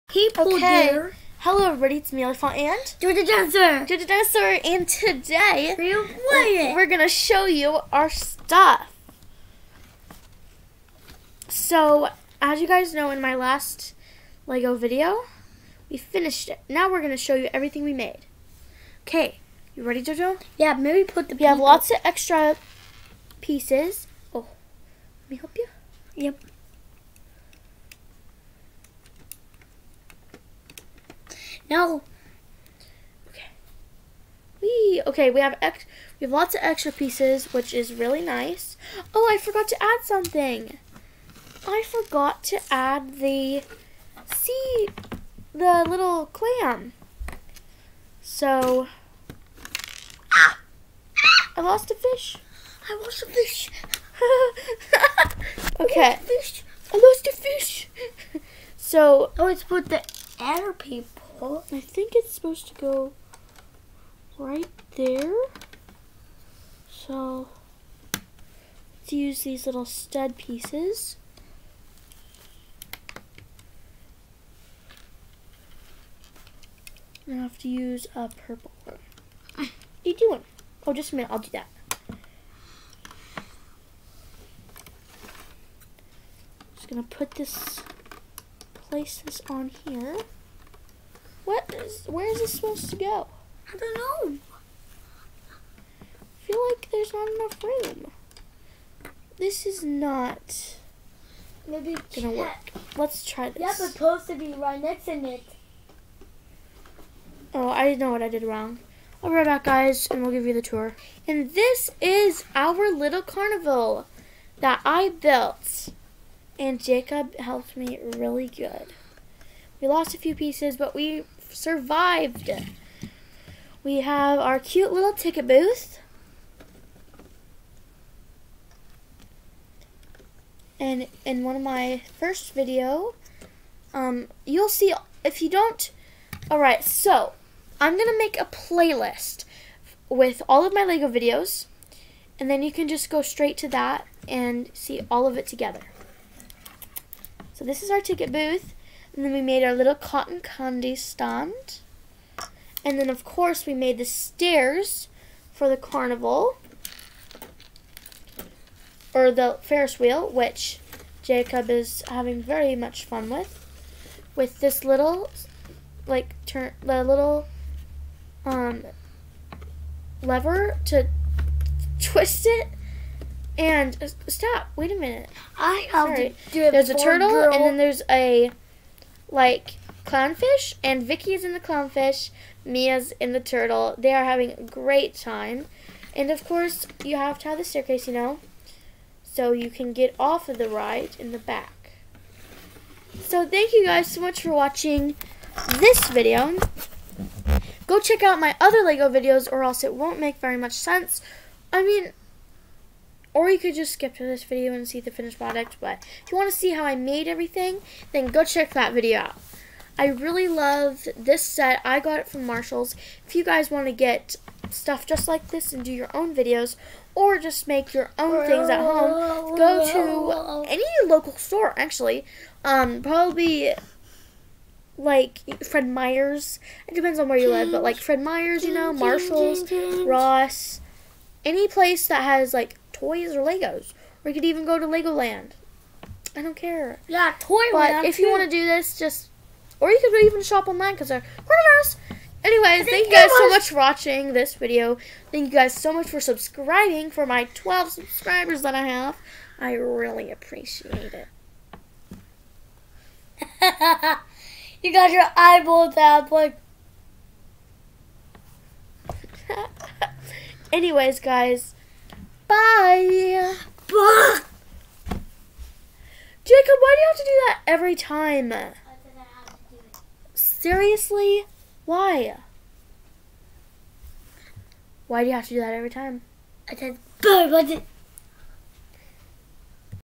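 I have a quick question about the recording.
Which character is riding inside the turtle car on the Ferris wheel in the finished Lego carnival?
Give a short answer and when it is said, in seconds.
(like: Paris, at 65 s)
Mia, at 182 s.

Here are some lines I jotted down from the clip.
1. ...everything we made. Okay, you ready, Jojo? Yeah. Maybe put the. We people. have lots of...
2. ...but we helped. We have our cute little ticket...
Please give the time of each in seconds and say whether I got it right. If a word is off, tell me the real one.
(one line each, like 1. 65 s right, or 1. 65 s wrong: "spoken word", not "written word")
1. 17 s right
2. 120 s wrong: "survived", not "helped".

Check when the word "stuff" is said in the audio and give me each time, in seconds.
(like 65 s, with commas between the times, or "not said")
8 s, 214 s.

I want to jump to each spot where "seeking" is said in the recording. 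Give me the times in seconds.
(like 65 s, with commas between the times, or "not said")
not said.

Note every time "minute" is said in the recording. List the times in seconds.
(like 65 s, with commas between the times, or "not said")
81 s, 174 s.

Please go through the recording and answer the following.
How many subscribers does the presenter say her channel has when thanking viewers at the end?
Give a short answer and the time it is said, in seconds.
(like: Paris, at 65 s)
12, at 247 s.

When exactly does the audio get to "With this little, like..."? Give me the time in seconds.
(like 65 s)
164 s.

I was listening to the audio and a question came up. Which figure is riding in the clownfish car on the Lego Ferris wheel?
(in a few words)
Vicky.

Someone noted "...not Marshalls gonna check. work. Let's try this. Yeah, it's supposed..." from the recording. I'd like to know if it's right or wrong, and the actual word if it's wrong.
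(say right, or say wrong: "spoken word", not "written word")
wrong: "Maybe", not "Marshalls".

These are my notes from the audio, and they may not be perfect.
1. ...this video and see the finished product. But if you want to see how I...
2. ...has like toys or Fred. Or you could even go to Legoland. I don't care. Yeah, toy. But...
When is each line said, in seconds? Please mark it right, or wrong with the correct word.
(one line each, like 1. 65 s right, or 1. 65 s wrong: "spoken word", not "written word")
1. 204 s right
2. 232 s wrong: "Legos", not "Fred".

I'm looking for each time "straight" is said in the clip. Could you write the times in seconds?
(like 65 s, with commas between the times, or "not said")
143 s.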